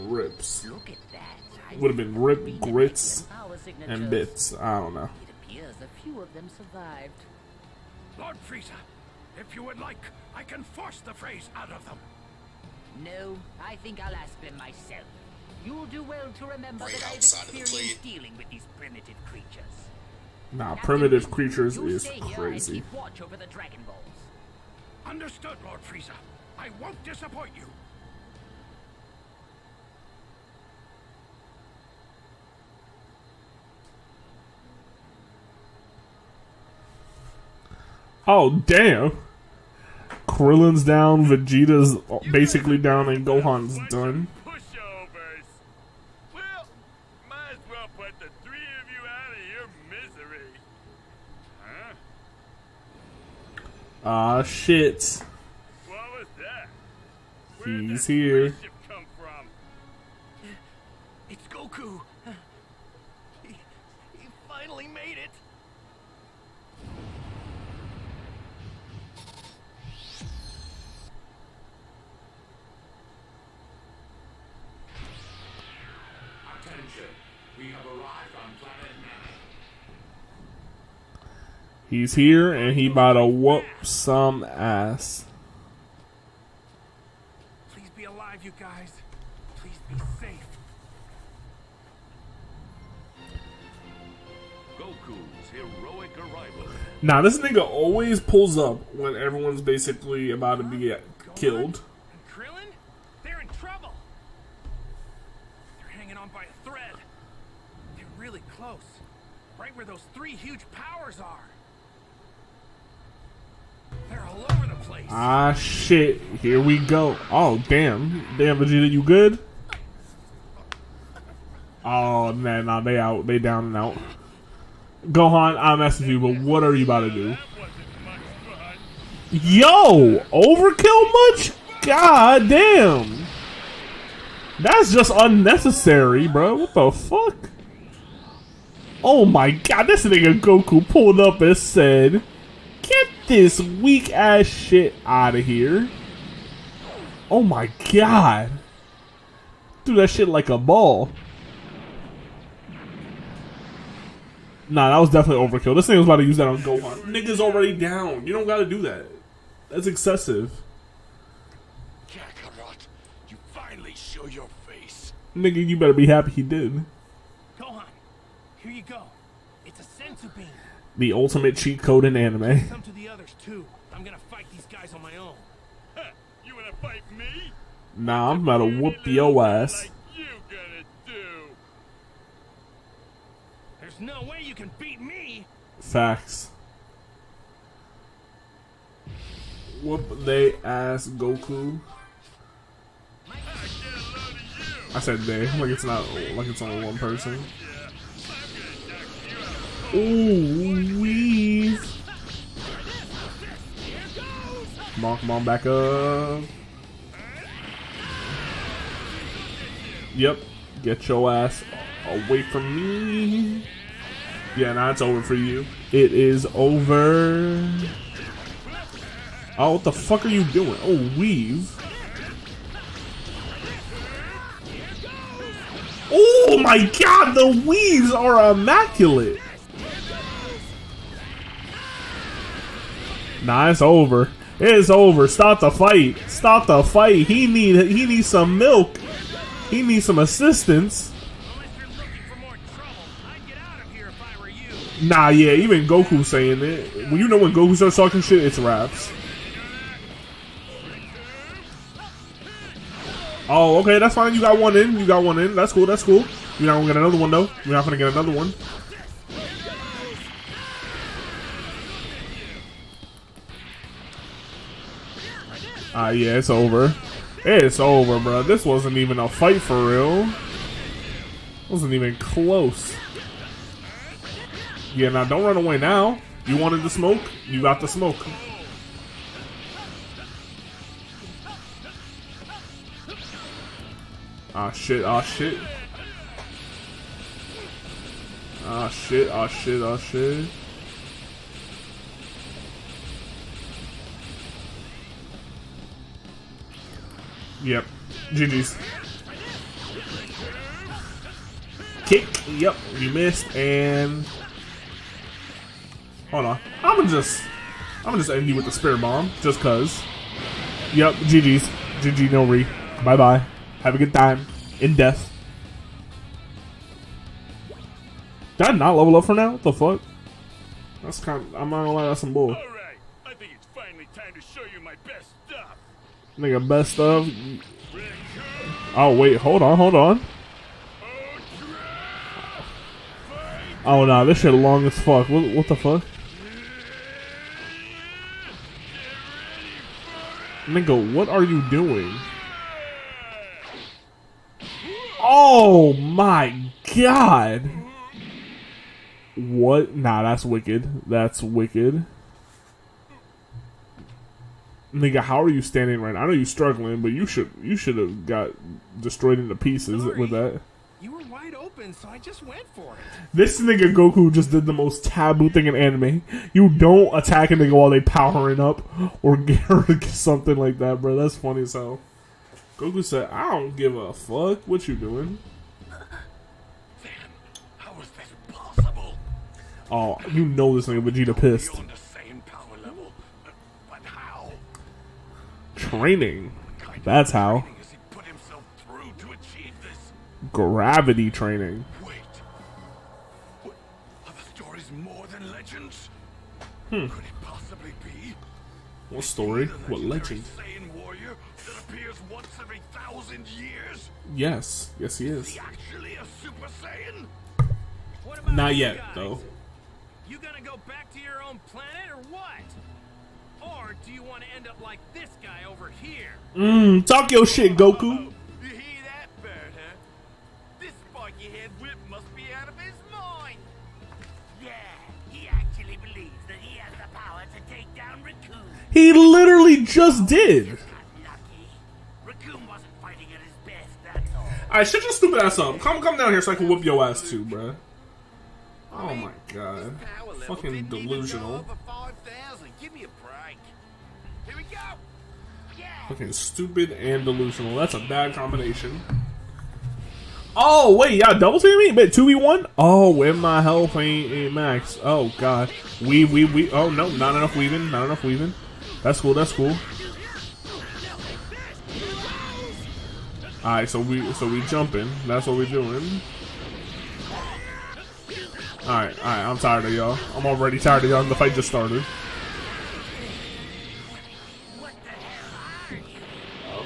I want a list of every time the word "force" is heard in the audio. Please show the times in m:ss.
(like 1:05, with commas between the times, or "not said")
0:10.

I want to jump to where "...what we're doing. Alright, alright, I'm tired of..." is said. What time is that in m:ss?
7:45.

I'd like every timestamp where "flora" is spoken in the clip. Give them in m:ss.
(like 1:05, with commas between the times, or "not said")
not said.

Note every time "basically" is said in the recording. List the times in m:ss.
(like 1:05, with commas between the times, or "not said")
0:42, 1:39.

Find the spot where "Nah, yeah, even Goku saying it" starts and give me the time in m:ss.
4:05.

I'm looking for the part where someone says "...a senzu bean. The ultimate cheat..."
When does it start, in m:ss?
2:49.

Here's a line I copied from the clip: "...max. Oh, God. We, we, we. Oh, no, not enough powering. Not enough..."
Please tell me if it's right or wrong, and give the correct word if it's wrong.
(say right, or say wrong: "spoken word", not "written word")
wrong: "weaving", not "powering".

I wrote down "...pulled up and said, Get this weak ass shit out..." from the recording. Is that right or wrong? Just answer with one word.
right.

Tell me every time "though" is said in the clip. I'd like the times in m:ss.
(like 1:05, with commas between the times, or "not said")
4:17, 6:49.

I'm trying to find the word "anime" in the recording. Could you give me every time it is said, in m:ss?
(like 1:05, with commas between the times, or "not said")
2:52, 6:05.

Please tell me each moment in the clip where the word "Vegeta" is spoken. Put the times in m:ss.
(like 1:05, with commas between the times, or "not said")
0:41, 1:58, 6:21.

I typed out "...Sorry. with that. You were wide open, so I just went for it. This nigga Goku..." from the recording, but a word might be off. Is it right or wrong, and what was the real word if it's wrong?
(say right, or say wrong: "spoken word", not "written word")
right.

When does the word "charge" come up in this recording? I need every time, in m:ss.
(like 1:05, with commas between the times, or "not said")
not said.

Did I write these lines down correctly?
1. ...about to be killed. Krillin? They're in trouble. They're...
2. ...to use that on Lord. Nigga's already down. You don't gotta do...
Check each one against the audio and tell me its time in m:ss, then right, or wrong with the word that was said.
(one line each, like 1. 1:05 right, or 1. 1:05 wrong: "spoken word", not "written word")
1. 1:40 right
2. 2:36 wrong: "Gohan", not "Lord".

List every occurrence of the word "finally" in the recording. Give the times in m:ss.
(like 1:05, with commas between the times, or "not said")
1:04, 2:43, 5:23.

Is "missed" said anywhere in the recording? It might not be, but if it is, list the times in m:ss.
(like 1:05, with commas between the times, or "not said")
5:03.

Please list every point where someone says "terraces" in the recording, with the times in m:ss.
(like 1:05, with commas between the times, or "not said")
not said.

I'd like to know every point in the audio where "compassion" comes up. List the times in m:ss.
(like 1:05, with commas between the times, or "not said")
not said.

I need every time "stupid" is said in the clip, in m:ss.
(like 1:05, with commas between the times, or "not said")
7:15, 7:26.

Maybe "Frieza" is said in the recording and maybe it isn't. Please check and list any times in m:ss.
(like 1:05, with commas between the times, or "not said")
0:08, 0:25.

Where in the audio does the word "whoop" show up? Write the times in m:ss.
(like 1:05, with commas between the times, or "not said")
1:23, 2:58, 3:09, 7:16.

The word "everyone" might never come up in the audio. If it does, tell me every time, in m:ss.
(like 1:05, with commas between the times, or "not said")
1:39.